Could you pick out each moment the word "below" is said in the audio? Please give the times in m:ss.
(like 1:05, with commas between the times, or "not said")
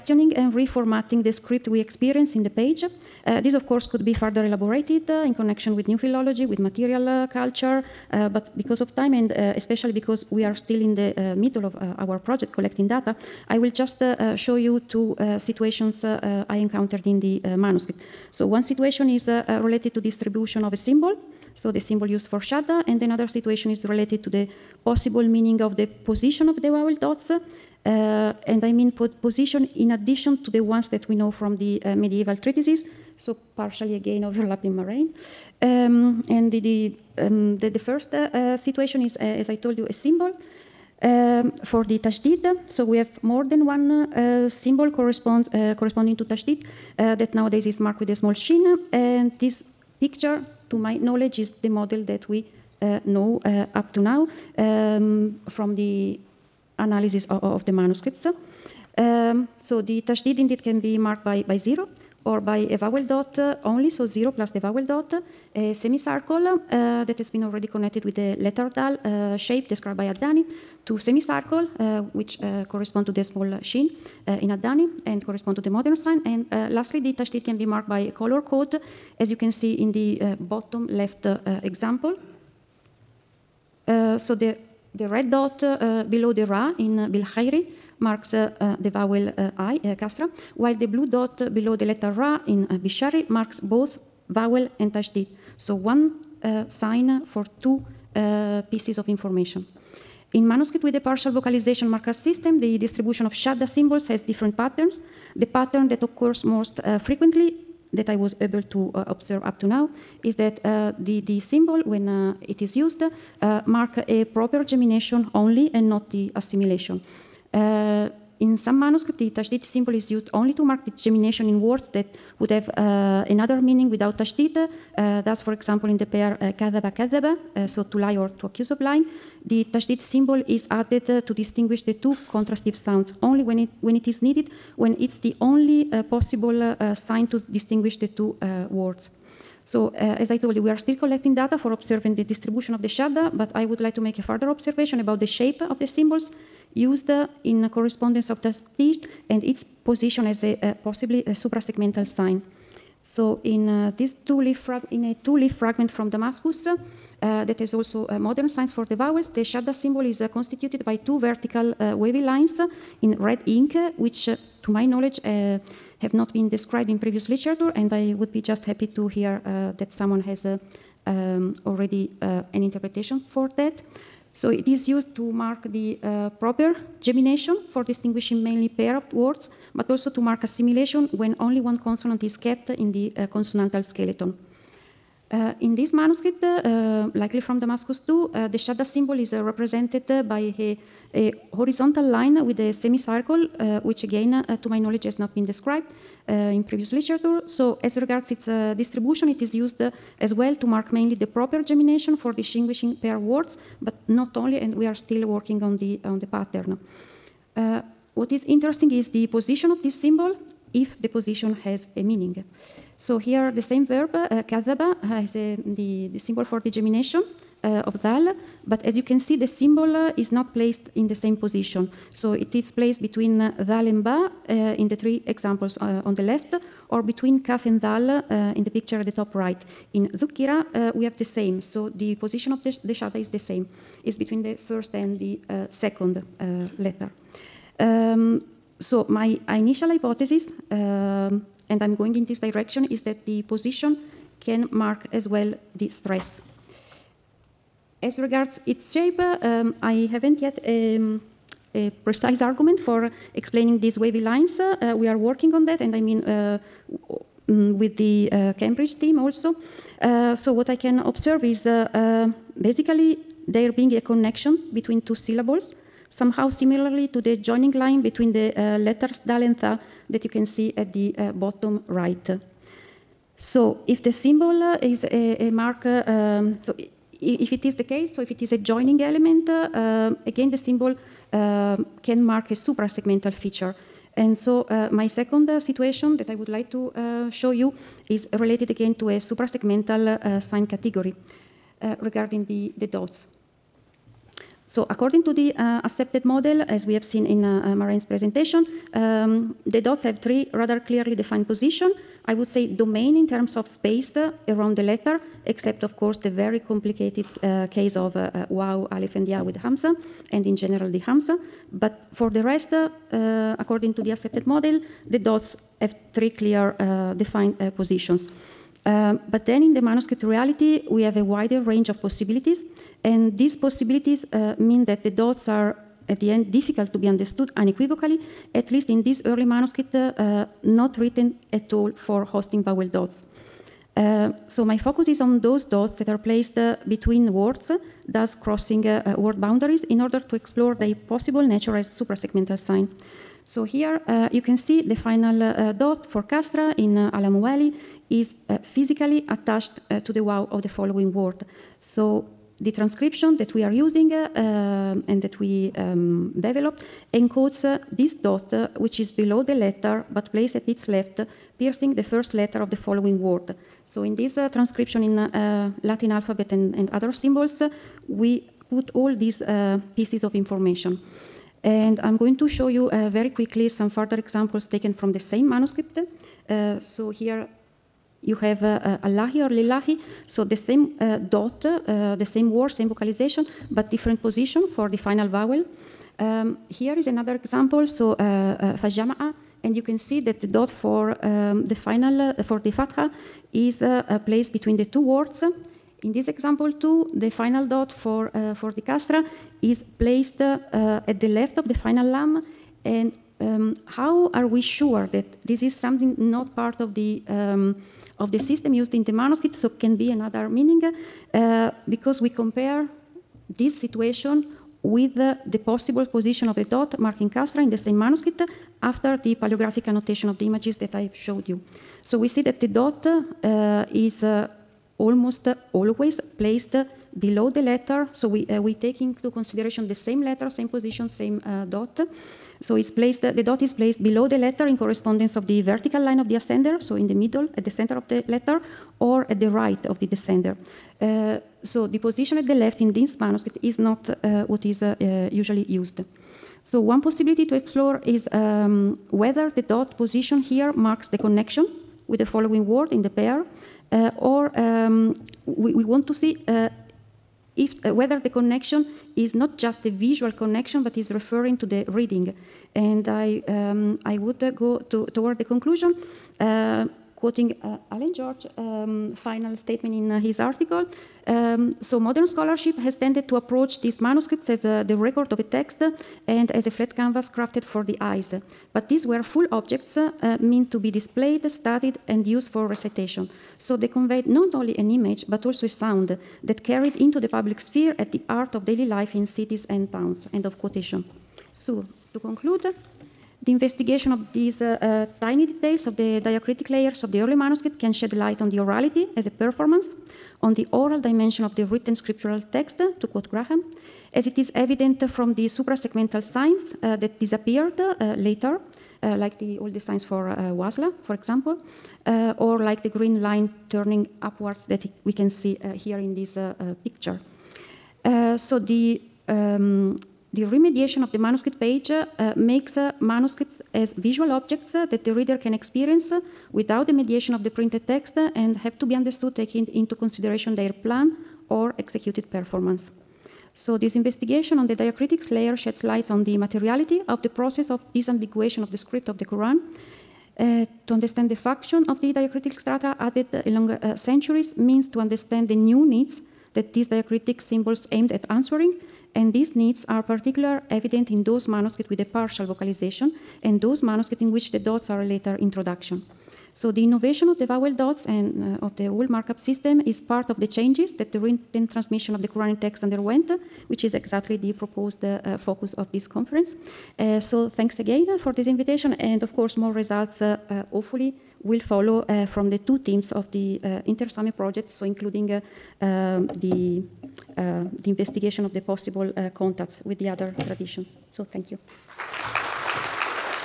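1:26, 1:31, 5:59, 7:07, 7:14.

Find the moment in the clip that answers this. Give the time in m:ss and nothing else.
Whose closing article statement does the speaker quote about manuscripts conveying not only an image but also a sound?
7:47.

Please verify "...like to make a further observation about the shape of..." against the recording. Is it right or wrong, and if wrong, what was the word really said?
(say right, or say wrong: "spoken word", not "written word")
right.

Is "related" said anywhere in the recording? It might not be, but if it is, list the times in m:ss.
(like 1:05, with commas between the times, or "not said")
0:19, 0:23, 4:48.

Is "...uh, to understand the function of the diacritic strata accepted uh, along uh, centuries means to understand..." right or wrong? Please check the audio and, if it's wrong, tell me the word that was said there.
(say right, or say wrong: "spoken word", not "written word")
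wrong: "added", not "accepted".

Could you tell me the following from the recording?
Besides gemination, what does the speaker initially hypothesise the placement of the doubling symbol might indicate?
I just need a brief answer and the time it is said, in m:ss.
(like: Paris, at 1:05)
Stress, at 4:05.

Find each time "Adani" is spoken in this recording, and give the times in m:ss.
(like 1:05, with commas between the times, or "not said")
1:10, 1:14.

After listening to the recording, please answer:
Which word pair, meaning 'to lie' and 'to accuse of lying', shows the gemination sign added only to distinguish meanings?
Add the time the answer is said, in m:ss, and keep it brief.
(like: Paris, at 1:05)
kadhaba kadhaba, at 2:06.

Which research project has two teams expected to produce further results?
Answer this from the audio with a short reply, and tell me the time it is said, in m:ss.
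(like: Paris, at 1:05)
InterSaME, at 9:33.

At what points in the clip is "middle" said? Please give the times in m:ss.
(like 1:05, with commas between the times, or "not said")
0:11, 7:17.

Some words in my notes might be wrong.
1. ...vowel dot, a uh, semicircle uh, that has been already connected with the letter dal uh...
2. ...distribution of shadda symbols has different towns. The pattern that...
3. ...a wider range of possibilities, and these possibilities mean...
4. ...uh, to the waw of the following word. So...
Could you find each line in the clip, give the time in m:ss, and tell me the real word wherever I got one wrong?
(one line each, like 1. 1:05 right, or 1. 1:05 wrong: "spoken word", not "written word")
1. 1:04 right
2. 1:42 wrong: "patterns", not "towns"
3. 5:21 right
4. 5:49 right.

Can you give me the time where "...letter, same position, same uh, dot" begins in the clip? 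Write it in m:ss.
7:10.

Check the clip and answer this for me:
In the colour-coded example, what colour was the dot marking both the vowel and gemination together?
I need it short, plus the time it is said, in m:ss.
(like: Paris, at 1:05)
Blue, at 1:30.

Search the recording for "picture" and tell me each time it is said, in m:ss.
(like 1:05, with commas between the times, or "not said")
0:49, 3:48, 8:36.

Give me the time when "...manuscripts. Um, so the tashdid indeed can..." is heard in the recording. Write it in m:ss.
0:57.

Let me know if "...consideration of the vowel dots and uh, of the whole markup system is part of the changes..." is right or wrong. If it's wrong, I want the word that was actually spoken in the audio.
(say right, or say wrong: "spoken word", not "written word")
wrong: "innovation", not "consideration".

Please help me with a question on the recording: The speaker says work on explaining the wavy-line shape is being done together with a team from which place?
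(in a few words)
Cambridge.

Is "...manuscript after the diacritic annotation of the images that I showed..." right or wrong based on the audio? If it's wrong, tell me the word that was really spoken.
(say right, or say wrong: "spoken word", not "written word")
wrong: "paleographic", not "diacritic".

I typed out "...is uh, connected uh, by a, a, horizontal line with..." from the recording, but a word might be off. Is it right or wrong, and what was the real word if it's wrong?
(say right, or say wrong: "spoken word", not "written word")
wrong: "represented", not "connected".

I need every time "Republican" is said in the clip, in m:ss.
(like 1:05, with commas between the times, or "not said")
not said.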